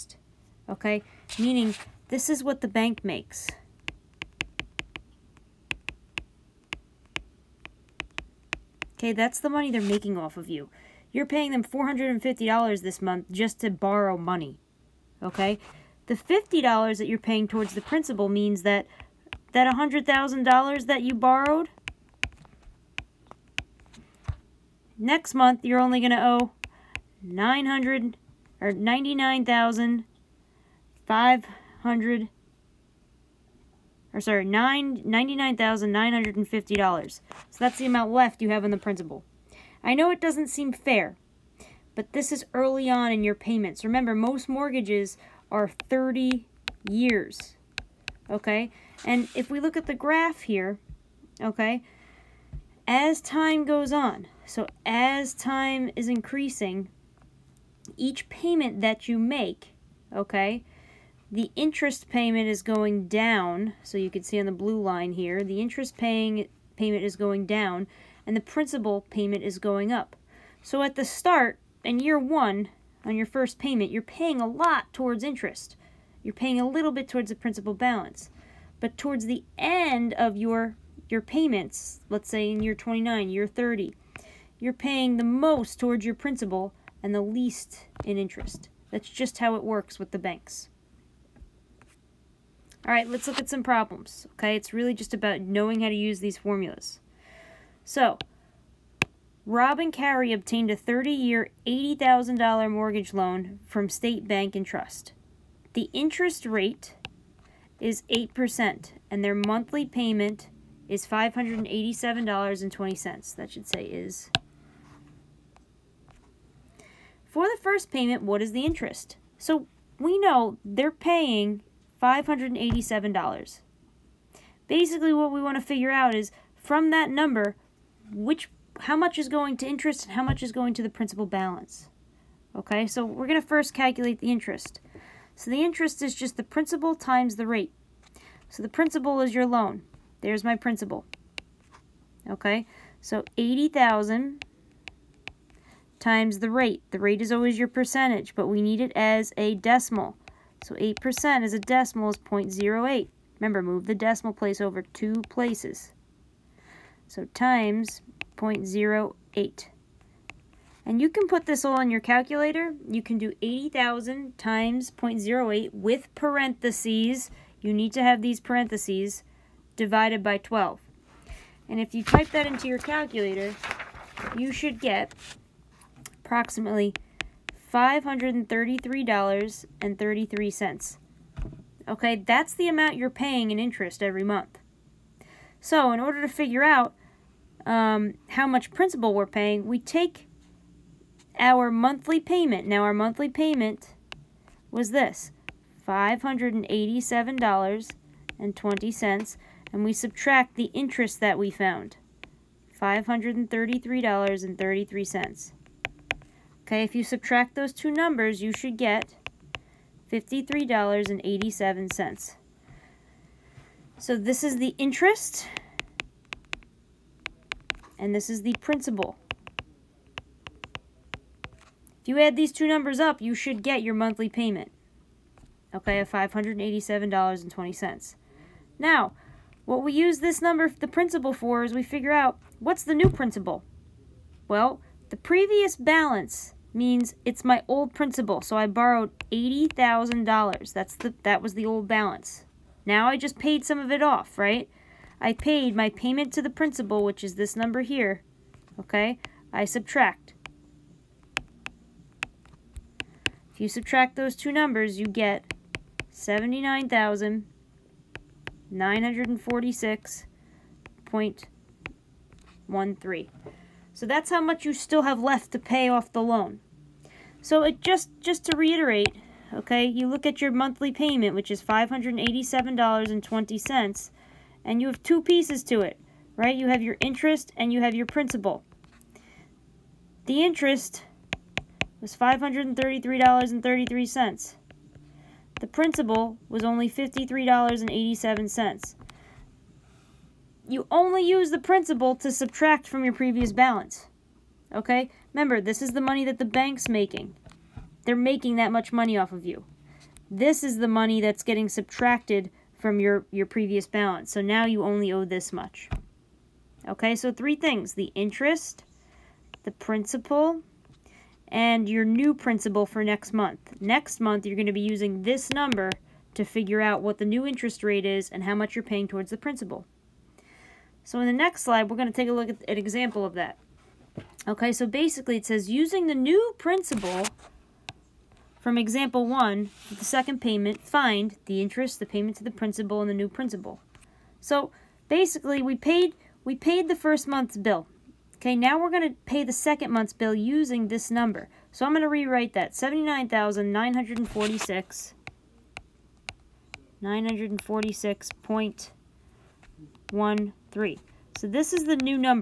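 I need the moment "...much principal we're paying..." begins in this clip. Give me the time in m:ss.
3:08.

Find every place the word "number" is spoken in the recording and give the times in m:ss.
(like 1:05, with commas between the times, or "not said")
2:07, 3:27, 3:42, 3:50, 4:07, 4:14, 5:15, 5:41.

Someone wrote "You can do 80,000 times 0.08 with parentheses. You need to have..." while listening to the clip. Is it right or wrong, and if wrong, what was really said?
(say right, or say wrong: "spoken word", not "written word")
right.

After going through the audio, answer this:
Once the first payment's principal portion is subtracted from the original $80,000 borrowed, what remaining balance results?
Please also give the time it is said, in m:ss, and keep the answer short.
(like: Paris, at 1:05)
79,946.13, at 4:16.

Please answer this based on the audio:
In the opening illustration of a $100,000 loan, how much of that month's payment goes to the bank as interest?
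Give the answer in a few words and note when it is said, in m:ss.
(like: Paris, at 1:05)
$450, at 0:11.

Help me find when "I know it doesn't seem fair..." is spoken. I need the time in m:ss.
0:39.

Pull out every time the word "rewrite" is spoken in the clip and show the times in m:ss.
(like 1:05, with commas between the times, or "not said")
5:42.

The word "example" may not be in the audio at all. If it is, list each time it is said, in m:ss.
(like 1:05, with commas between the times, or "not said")
5:22, 5:28.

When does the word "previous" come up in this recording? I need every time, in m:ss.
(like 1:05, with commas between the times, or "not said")
3:55, 4:53, 5:03.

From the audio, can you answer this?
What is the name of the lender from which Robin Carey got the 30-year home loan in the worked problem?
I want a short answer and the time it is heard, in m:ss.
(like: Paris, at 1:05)
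State Bank and Trust, at 1:43.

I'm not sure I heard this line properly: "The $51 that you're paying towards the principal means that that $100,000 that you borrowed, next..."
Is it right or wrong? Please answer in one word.
wrong.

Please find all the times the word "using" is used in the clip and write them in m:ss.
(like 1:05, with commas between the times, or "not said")
5:14, 5:25, 5:40.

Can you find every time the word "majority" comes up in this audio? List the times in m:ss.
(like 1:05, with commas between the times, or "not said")
not said.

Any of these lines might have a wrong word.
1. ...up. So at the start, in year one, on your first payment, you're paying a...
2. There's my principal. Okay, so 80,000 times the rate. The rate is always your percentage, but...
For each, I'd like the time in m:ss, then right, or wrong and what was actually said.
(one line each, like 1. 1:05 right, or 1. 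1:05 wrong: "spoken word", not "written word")
1. 1:09 right
2. 2:20 right.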